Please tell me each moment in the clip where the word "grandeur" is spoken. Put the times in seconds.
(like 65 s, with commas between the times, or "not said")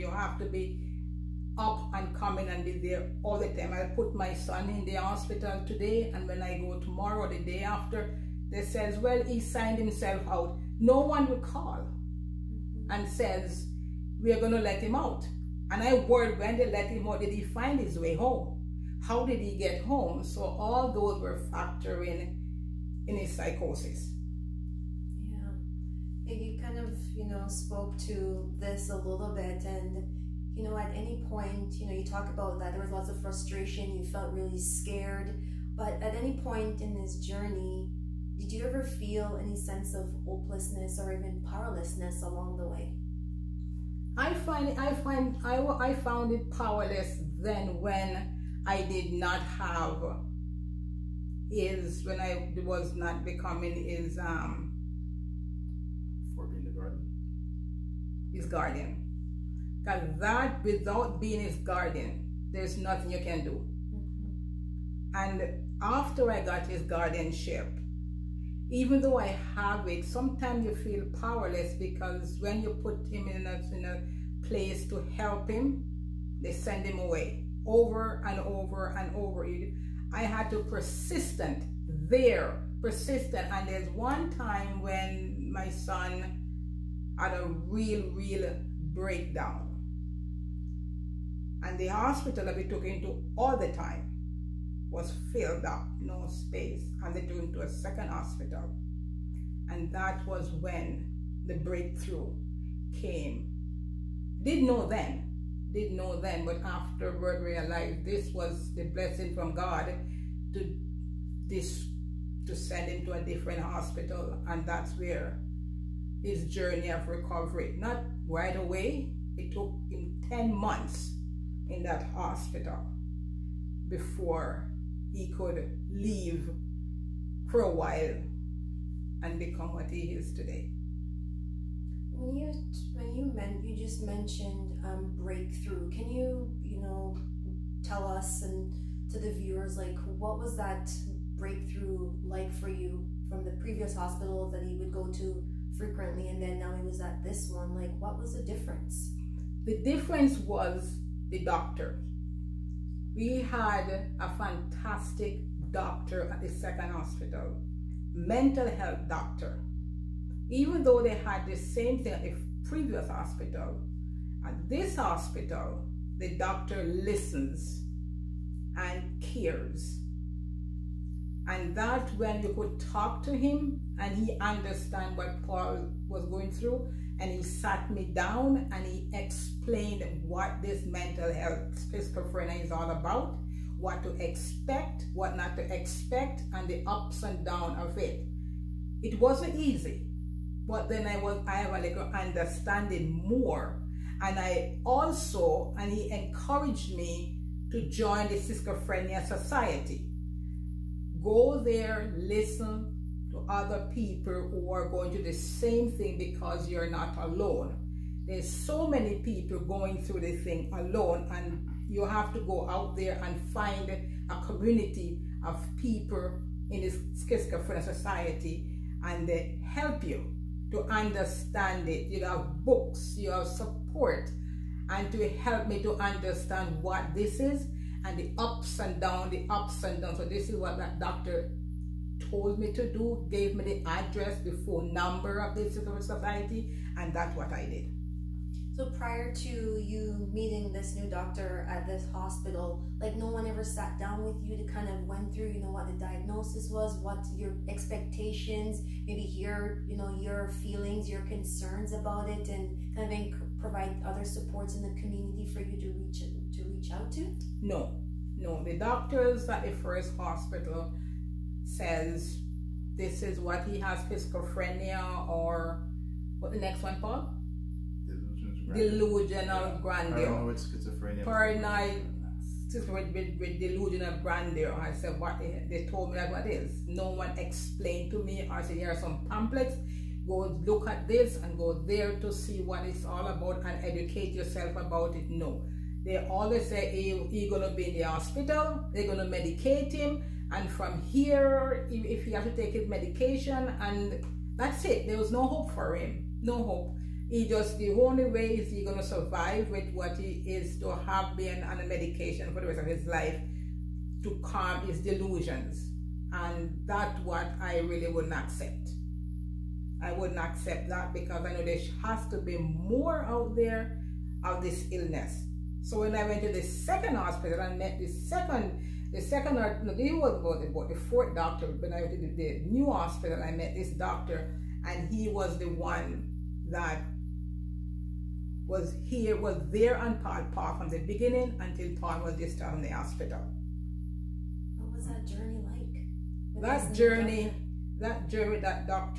269 s, 274 s.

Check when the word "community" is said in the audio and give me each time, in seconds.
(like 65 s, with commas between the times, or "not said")
214 s, 254 s.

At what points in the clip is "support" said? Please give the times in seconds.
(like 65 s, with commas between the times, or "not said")
223 s, 254 s.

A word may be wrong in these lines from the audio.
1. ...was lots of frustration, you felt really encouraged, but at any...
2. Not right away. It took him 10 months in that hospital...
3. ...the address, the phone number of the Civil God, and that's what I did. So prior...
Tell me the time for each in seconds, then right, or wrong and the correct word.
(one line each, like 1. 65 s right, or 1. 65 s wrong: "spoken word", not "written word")
1. 32 s wrong: "scared", not "encouraged"
2. 117 s right
3. 233 s wrong: "Society", not "God".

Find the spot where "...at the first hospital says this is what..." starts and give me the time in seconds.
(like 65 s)
259 s.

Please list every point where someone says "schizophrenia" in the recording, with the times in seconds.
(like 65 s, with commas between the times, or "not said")
181 s, 198 s, 217 s, 264 s, 270 s.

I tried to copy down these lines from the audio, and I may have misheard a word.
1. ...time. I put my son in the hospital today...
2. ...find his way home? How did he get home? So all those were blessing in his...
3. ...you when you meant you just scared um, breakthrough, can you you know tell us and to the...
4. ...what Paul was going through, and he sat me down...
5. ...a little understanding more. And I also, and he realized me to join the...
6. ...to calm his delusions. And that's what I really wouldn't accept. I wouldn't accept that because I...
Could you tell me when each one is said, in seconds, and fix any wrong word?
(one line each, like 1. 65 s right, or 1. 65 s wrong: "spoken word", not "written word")
1. 3 s right
2. 17 s wrong: "factoring", not "blessing"
3. 132 s wrong: "mentioned", not "scared"
4. 175 s right
5. 191 s wrong: "encouraged", not "realized"
6. 304 s right.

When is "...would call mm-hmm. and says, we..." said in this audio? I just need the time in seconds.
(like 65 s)
11 s.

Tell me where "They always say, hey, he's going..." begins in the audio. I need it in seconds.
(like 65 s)
286 s.